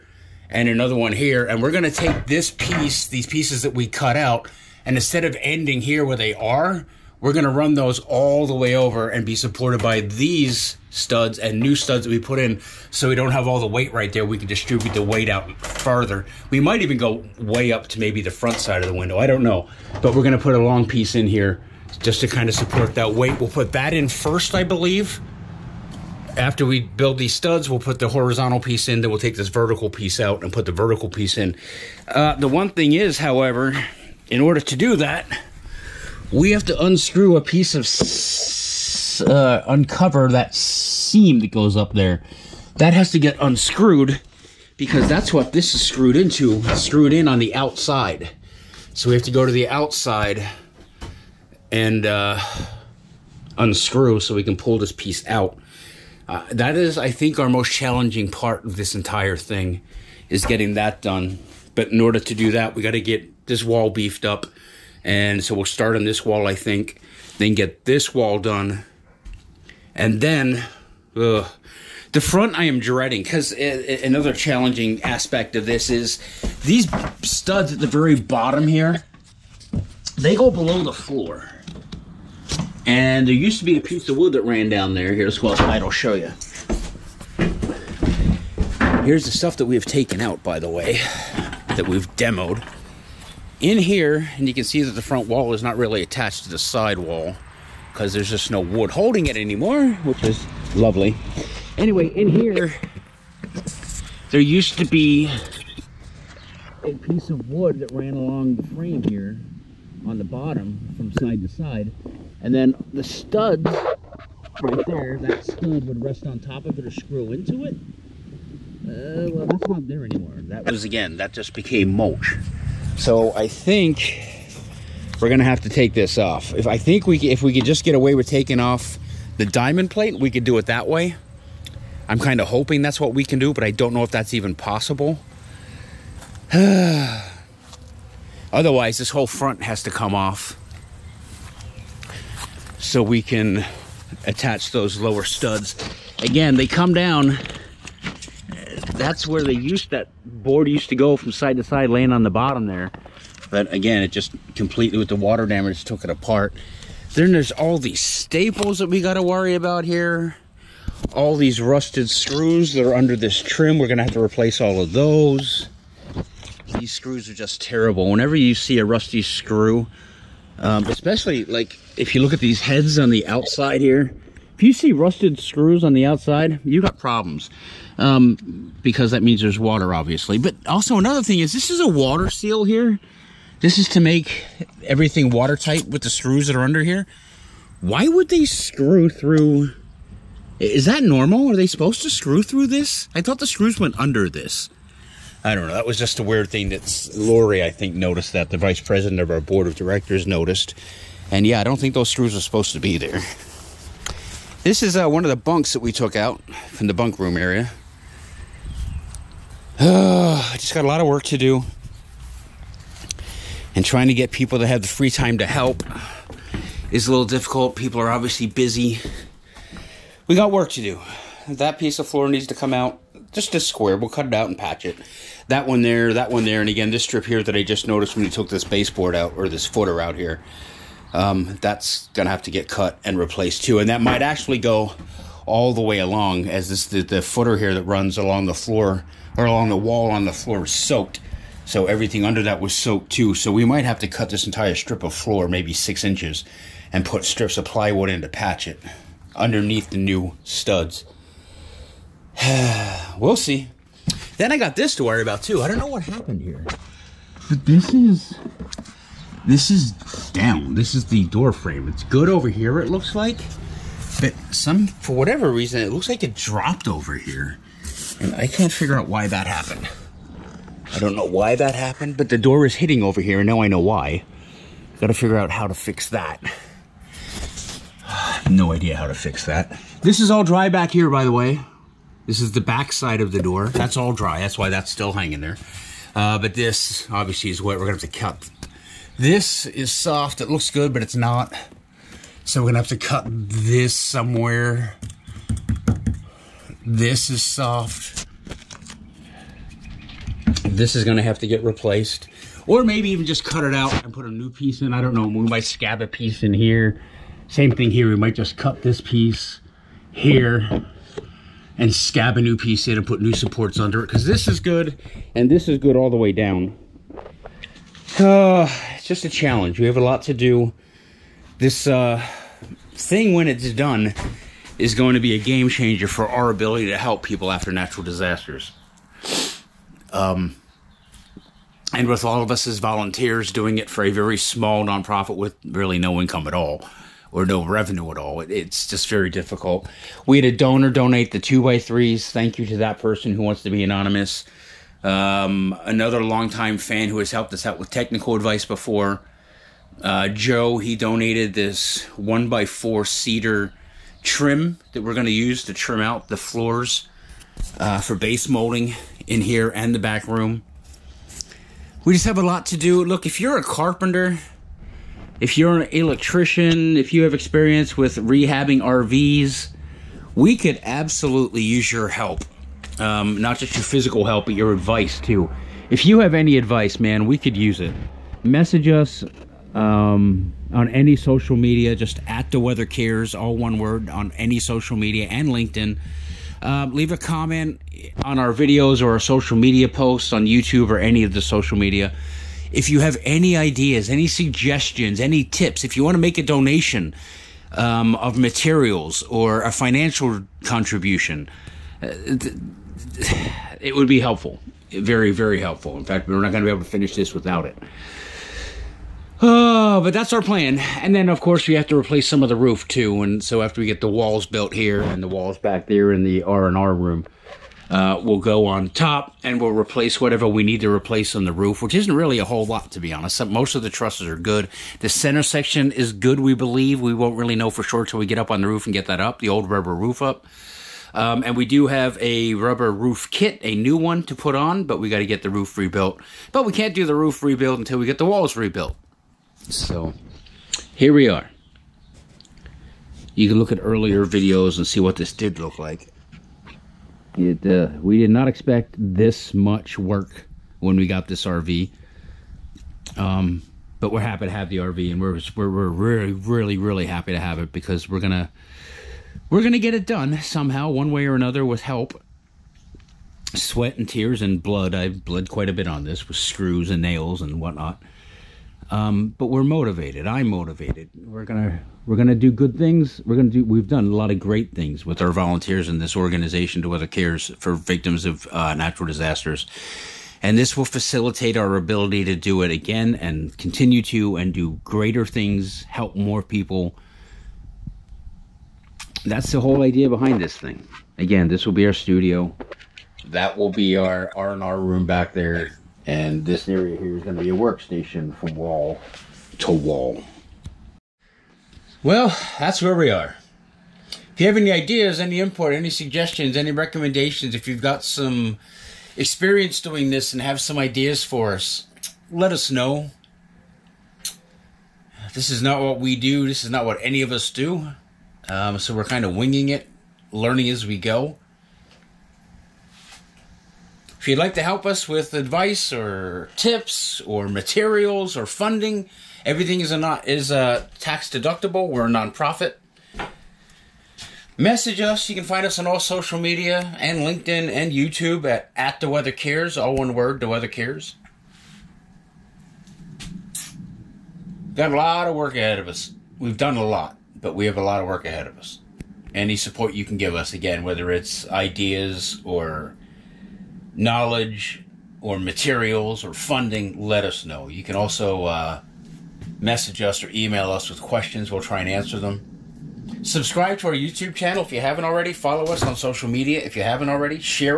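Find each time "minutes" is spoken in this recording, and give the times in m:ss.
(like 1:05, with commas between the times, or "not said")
not said.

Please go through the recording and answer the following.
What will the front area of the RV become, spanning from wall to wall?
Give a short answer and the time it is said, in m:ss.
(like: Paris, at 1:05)
A workstation, at 8:17.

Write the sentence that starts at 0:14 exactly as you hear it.
We can distribute the weight out further.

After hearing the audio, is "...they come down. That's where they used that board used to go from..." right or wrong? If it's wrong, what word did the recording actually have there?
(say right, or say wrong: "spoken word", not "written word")
right.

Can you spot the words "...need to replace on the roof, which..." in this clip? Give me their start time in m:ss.
7:00.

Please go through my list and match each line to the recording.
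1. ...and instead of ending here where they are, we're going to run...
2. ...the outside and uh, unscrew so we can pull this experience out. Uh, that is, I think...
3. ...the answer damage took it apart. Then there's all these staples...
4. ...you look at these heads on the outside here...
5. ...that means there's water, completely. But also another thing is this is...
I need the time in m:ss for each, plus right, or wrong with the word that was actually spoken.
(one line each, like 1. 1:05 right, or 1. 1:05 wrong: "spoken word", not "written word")
1. 0:04 right
2. 0:49 wrong: "piece", not "experience"
3. 2:35 wrong: "water", not "answer"
4. 2:52 right
5. 2:59 wrong: "obviously", not "completely".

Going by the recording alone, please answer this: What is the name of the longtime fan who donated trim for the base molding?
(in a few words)
Joe.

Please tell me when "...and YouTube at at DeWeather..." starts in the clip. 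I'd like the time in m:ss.
8:57.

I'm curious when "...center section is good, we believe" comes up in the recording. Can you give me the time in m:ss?
7:05.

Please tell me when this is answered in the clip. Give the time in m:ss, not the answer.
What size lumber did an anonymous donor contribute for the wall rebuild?
5:41.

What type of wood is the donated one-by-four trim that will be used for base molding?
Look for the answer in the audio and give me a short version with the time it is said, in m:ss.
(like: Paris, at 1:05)
Cedar, at 5:53.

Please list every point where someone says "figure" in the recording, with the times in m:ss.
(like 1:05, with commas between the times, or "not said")
4:28, 4:35.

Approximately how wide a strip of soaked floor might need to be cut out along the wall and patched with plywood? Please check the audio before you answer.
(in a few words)
6 inches.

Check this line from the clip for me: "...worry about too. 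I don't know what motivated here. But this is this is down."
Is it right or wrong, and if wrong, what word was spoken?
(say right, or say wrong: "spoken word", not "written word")
wrong: "happened", not "motivated".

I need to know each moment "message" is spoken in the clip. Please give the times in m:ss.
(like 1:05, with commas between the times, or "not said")
6:18, 8:54, 9:19.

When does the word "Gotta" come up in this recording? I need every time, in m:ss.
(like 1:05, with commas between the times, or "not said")
4:35.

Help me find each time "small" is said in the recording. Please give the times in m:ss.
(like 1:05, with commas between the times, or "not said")
5:34.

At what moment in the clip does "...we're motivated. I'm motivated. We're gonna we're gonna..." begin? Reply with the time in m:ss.
7:49.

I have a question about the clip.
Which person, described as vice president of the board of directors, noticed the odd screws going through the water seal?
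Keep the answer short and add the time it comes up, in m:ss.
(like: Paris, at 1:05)
Lori, at 3:17.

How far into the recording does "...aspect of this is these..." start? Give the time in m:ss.
1:15.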